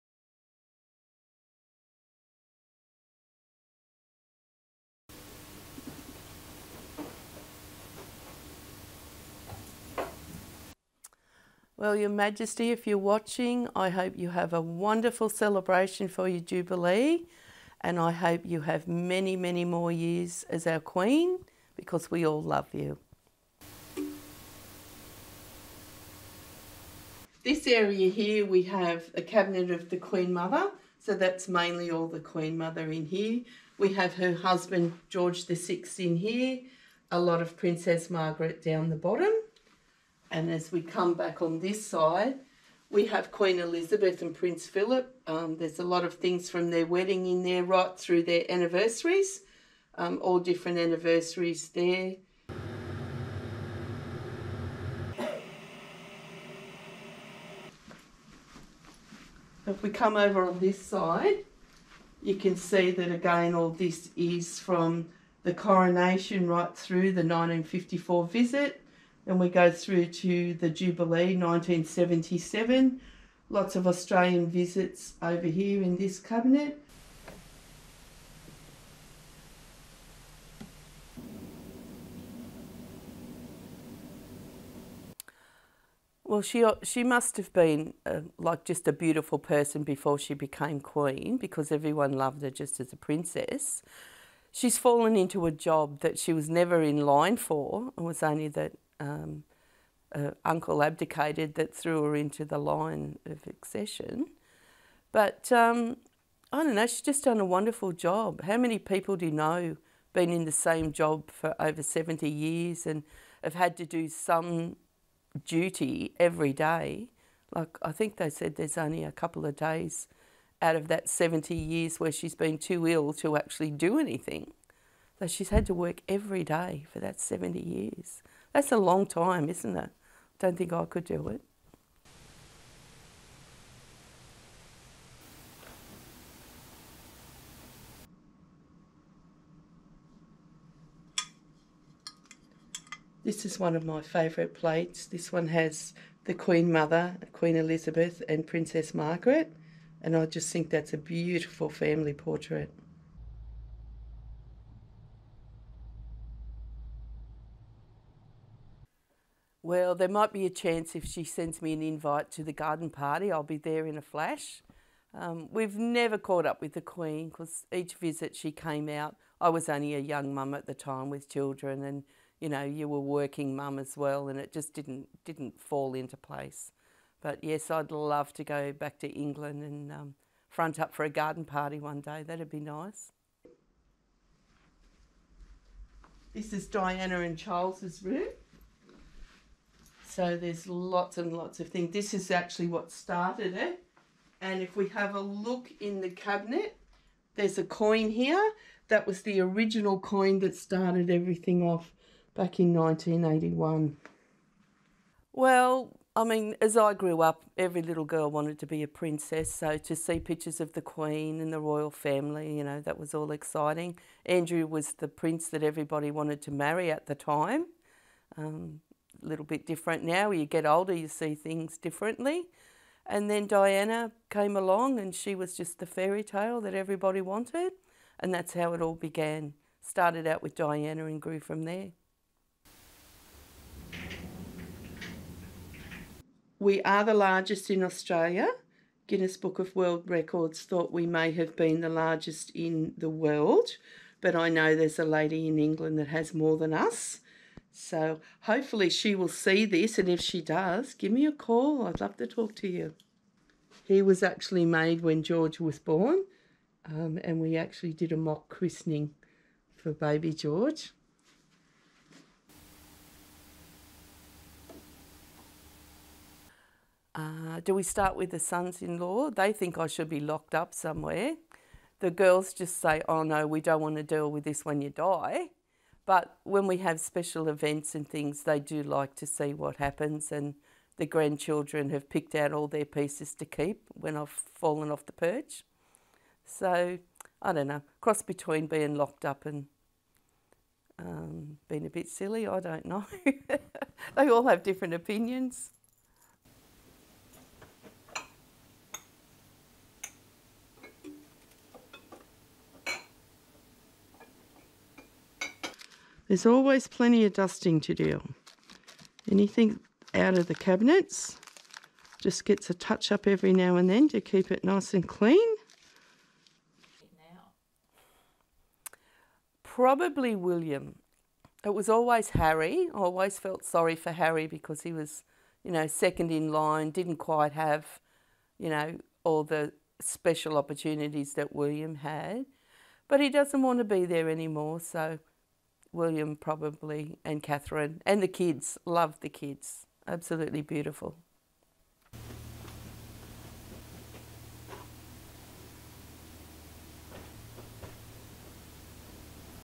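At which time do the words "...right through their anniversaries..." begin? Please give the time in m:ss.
0:47.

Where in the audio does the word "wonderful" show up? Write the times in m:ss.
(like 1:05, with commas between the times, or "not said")
0:14, 1:47.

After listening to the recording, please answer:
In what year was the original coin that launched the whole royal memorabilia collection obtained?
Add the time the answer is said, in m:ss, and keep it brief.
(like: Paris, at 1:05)
1981, at 3:22.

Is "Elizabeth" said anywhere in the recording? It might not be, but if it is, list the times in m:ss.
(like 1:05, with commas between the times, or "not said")
0:43, 2:27.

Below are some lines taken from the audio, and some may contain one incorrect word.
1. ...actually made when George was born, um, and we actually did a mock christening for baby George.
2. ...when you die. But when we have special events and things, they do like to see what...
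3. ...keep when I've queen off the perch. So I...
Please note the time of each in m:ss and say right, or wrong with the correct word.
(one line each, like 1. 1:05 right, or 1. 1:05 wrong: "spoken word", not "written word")
1. 4:14 right
2. 4:34 right
3. 4:43 wrong: "fallen", not "queen".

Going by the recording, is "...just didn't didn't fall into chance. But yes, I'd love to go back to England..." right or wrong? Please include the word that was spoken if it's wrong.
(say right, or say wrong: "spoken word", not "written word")
wrong: "place", not "chance".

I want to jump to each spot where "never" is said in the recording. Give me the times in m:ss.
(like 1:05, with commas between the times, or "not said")
1:36, 2:45.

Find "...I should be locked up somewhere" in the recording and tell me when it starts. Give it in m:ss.
4:29.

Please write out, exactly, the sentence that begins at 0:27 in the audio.
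This area here, we have the cabinet of the Queen Mother, so that's mainly all the Queen Mother in here.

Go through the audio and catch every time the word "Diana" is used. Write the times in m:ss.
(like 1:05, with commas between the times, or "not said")
3:06, 3:43, 3:50.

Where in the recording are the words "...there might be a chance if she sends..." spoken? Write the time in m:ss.
2:39.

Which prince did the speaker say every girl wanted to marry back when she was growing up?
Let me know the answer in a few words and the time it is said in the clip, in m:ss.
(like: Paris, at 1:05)
Andrew, at 3:34.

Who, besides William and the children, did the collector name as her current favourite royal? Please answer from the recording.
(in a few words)
Catherine.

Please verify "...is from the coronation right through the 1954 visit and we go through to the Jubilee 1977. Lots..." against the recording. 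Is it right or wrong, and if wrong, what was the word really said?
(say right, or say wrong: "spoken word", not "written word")
right.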